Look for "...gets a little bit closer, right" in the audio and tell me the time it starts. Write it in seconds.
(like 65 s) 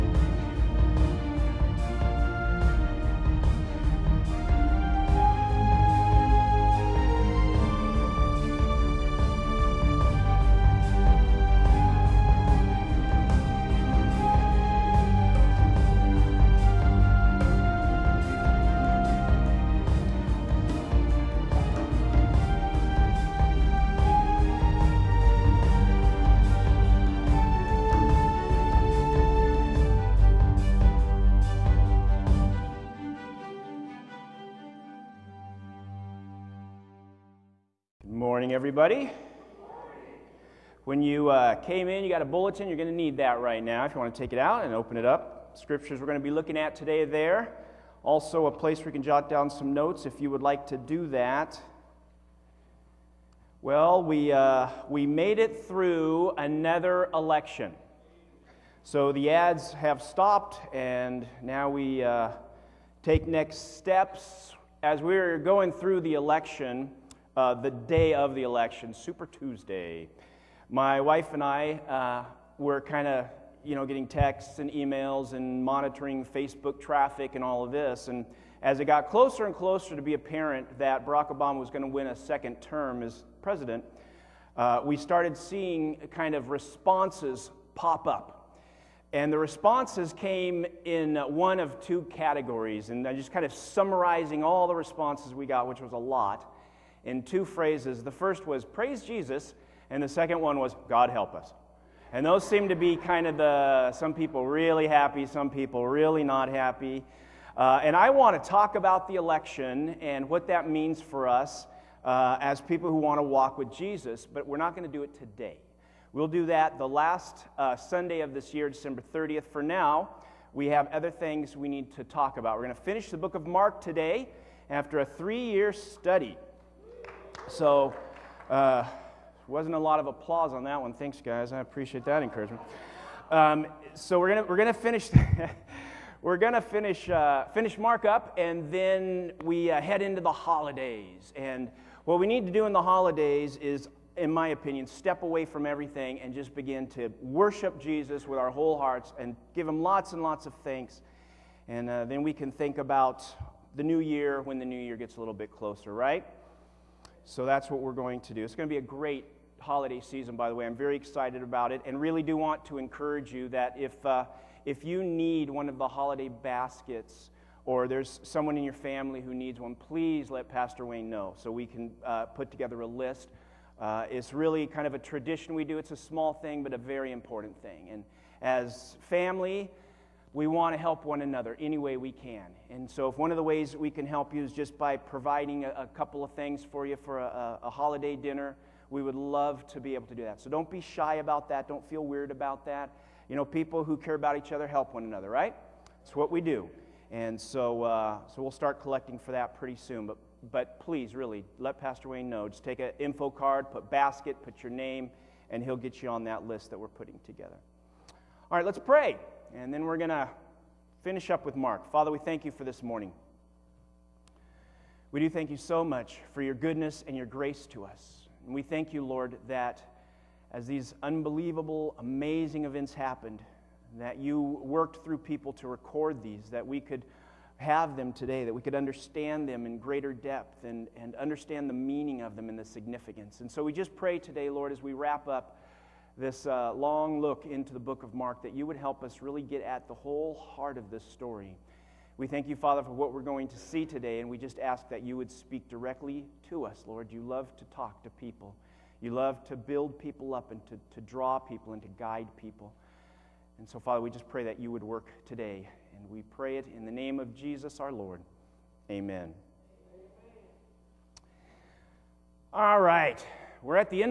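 154 s.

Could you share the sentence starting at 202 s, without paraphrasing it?
Just take an info card, put basket, put your name, and he'll get you on that list that we're putting together.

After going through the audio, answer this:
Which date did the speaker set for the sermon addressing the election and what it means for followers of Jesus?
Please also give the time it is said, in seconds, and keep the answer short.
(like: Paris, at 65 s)
December 30th, at 118 s.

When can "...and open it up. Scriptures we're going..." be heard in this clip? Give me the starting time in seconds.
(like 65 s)
44 s.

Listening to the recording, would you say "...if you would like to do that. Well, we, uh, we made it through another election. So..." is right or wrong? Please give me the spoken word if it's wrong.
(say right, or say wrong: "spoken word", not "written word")
right.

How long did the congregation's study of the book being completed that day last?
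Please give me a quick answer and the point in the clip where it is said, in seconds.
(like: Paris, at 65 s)
3 years, at 125 s.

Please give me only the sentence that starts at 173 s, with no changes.
Uh, it's really kind of a tradition we do.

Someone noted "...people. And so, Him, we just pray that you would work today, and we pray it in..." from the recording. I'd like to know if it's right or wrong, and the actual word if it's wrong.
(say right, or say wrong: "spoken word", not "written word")
wrong: "Father", not "Him".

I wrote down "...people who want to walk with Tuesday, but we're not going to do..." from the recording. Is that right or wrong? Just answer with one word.
wrong.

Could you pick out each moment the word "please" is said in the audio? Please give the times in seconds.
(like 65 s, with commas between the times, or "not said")
169 s, 200 s.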